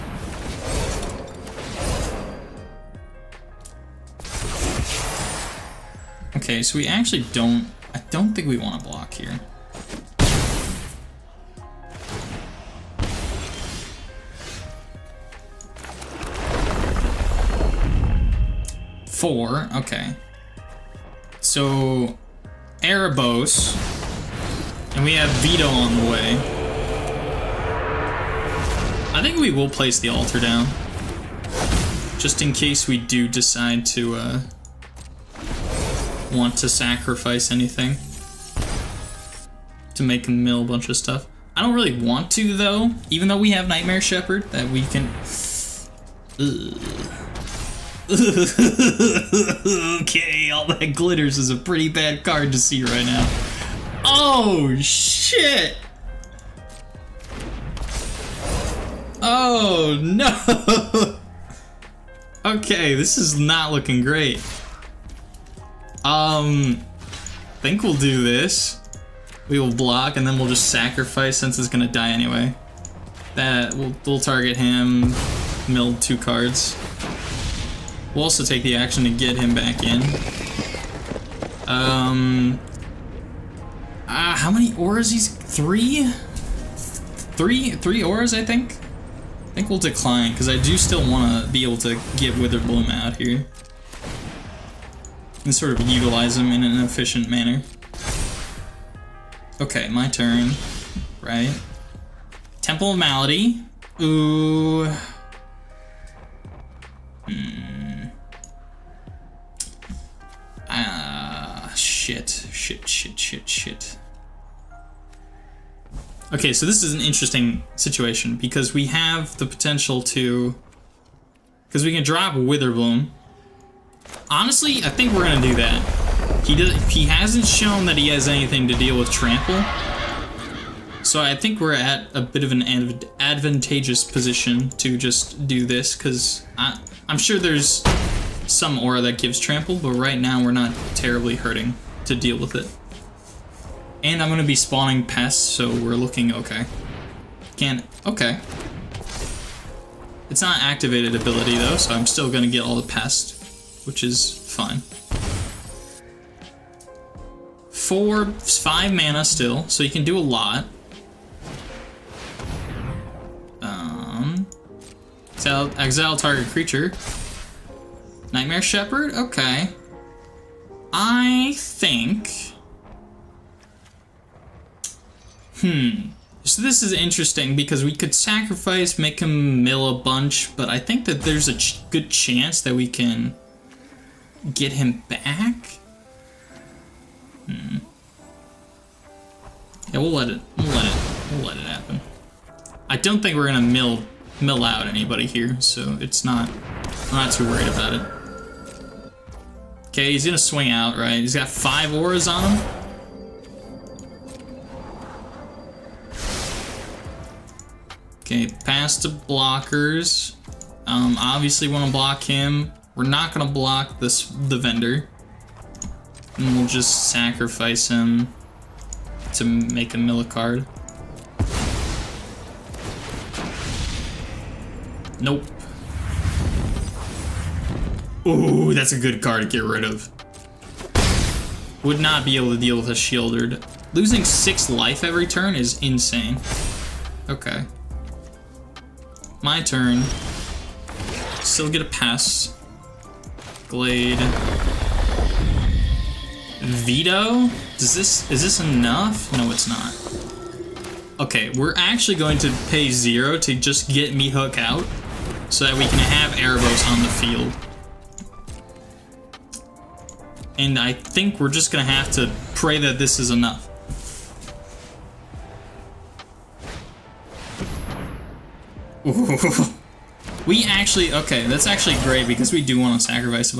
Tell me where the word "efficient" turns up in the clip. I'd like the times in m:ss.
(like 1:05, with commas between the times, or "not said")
1:36.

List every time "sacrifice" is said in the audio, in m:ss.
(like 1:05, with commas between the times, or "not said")
0:36, 1:10, 2:58, 3:37, 4:33.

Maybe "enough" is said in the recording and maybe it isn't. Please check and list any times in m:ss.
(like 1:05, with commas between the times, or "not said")
4:08, 4:23.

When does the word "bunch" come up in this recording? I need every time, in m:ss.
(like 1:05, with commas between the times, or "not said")
0:40, 3:00.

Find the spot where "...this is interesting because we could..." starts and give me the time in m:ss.
2:56.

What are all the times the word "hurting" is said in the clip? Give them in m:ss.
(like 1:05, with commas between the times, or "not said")
2:21.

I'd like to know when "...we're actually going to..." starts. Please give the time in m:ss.
4:11.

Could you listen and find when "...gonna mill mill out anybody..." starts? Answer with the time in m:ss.
3:13.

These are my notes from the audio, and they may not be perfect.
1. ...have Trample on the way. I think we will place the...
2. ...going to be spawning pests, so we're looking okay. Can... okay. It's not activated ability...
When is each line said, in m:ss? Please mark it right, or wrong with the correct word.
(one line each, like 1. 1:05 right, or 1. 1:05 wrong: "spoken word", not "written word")
1. 0:25 wrong: "Vito", not "Trample"
2. 2:24 right.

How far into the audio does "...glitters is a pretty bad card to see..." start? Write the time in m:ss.
0:50.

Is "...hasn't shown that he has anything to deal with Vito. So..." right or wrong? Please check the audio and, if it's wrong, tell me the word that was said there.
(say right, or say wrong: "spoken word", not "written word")
wrong: "Trample", not "Vito".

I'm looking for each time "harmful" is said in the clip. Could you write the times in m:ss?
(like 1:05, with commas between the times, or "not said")
not said.